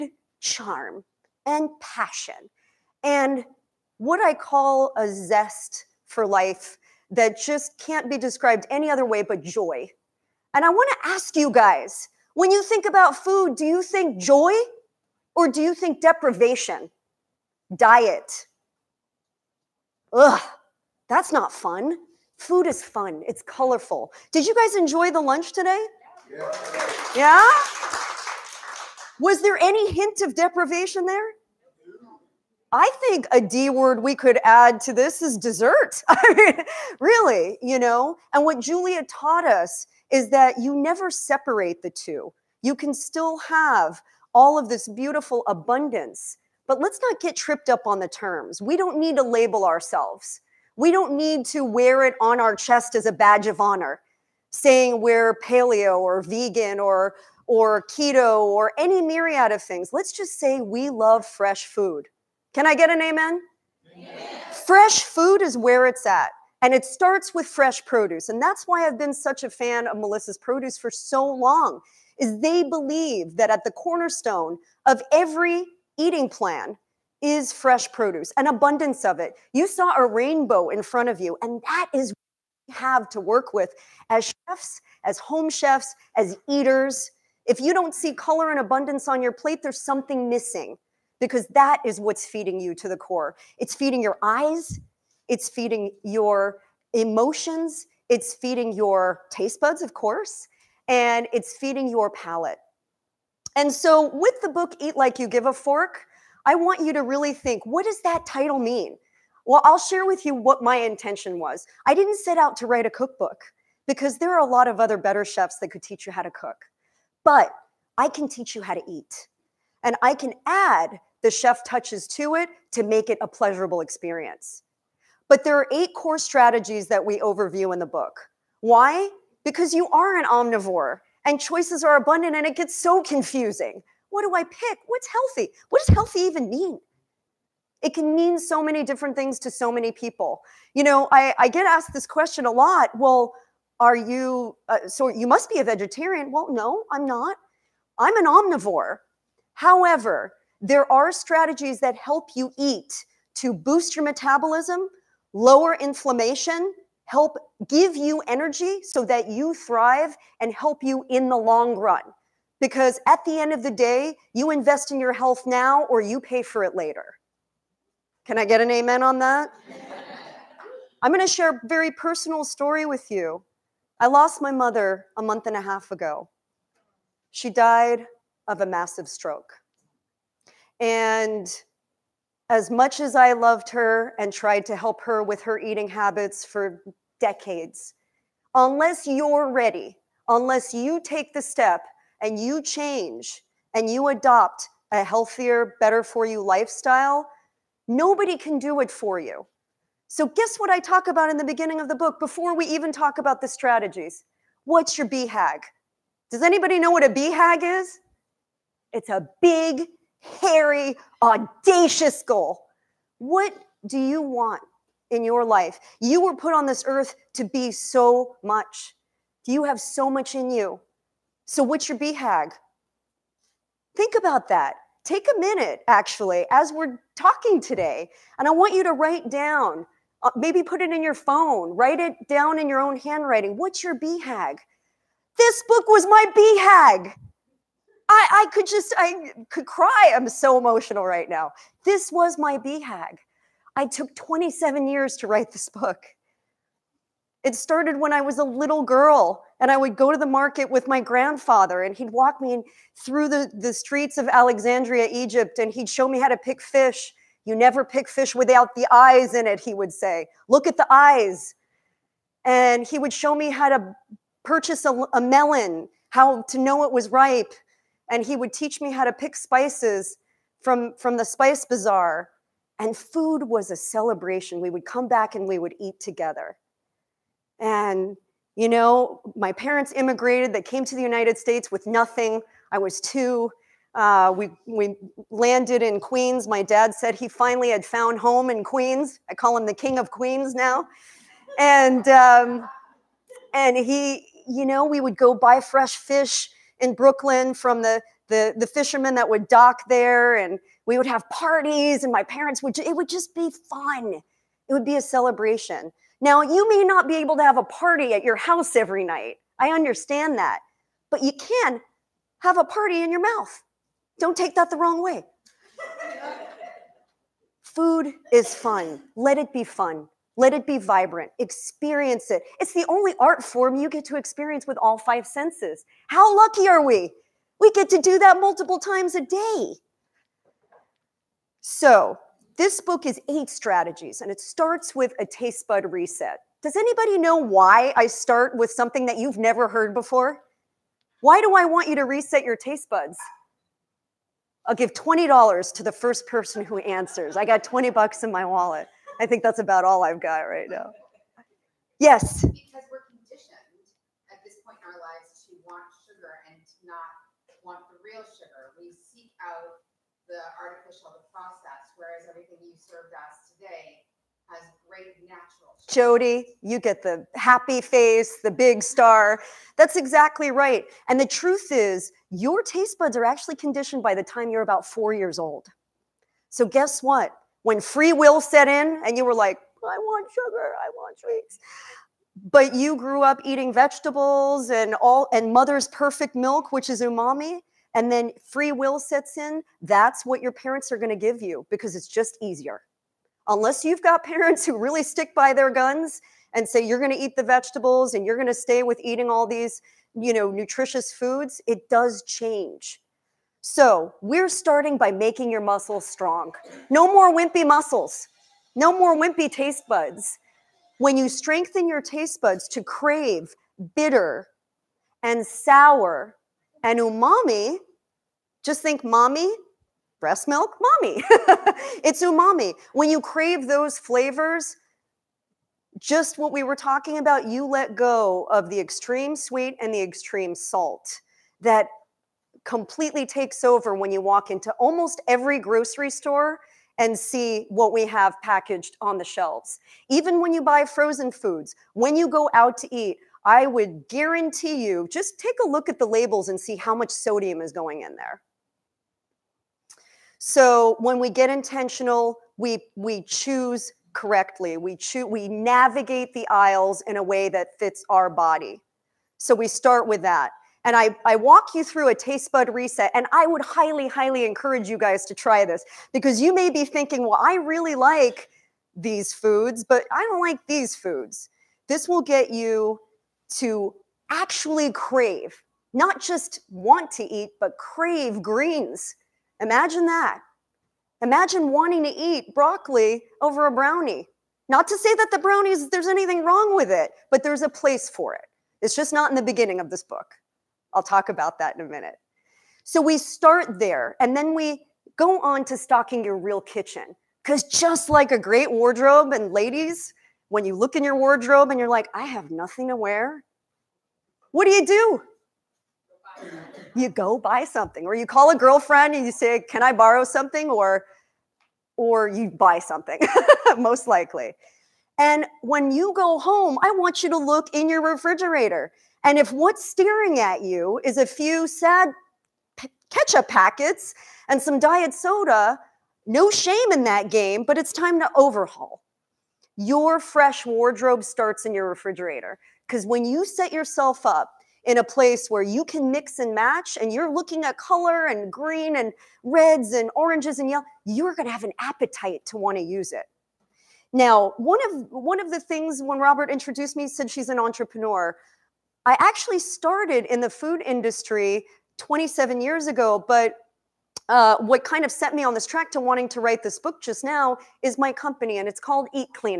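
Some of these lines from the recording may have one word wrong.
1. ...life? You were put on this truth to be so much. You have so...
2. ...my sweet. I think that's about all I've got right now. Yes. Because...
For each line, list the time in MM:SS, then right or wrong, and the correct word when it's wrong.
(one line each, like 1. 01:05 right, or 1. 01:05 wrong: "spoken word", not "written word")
1. 03:35 wrong: "earth", not "truth"
2. 05:48 wrong: "wallet", not "sweet".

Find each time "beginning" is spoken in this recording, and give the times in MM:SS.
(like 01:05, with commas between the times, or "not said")
03:21, 08:09.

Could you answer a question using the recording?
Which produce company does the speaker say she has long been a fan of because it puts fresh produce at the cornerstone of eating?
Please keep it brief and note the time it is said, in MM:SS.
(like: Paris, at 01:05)
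Melissa's, at 01:09.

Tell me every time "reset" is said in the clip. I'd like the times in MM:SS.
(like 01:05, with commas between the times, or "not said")
05:35, 05:42, 07:42.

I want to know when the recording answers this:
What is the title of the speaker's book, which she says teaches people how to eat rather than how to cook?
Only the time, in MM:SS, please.
01:44.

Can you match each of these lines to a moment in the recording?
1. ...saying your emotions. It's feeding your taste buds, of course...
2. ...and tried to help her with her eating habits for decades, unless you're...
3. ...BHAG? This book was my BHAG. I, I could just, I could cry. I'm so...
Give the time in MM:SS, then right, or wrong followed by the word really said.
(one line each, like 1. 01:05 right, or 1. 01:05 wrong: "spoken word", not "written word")
1. 01:35 wrong: "feeding", not "saying"
2. 03:04 right
3. 03:53 right.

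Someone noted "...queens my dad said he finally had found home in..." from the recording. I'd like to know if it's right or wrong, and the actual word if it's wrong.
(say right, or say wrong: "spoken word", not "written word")
right.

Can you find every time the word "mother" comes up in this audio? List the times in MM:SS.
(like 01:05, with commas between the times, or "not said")
02:54, 06:25.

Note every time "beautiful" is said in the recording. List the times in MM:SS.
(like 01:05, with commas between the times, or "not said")
00:44.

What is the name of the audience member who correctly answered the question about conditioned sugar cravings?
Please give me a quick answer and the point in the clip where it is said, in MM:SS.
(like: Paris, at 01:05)
Jody, at 06:05.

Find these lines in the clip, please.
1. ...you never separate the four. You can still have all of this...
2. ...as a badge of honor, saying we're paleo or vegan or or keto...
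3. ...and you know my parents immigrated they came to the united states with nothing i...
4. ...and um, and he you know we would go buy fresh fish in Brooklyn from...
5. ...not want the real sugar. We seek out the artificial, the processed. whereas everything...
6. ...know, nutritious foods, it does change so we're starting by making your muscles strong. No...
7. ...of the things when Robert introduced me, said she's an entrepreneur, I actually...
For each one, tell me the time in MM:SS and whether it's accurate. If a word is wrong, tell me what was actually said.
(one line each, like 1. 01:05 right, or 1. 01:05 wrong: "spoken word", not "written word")
1. 00:40 wrong: "two", not "four"
2. 00:52 right
3. 04:37 right
4. 04:51 right
5. 05:56 right
6. 06:40 right
7. 09:05 right.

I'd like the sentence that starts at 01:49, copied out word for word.
Well, I'll share with you what my intention was.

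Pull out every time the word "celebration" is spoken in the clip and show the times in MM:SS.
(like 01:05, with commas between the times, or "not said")
04:33, 05:05.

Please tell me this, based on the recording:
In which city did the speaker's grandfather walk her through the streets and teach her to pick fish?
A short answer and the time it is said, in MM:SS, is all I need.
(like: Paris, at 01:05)
Alexandria, Egypt, at 04:14.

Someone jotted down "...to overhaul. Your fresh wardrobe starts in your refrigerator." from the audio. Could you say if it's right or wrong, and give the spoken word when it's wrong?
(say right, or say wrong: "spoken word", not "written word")
right.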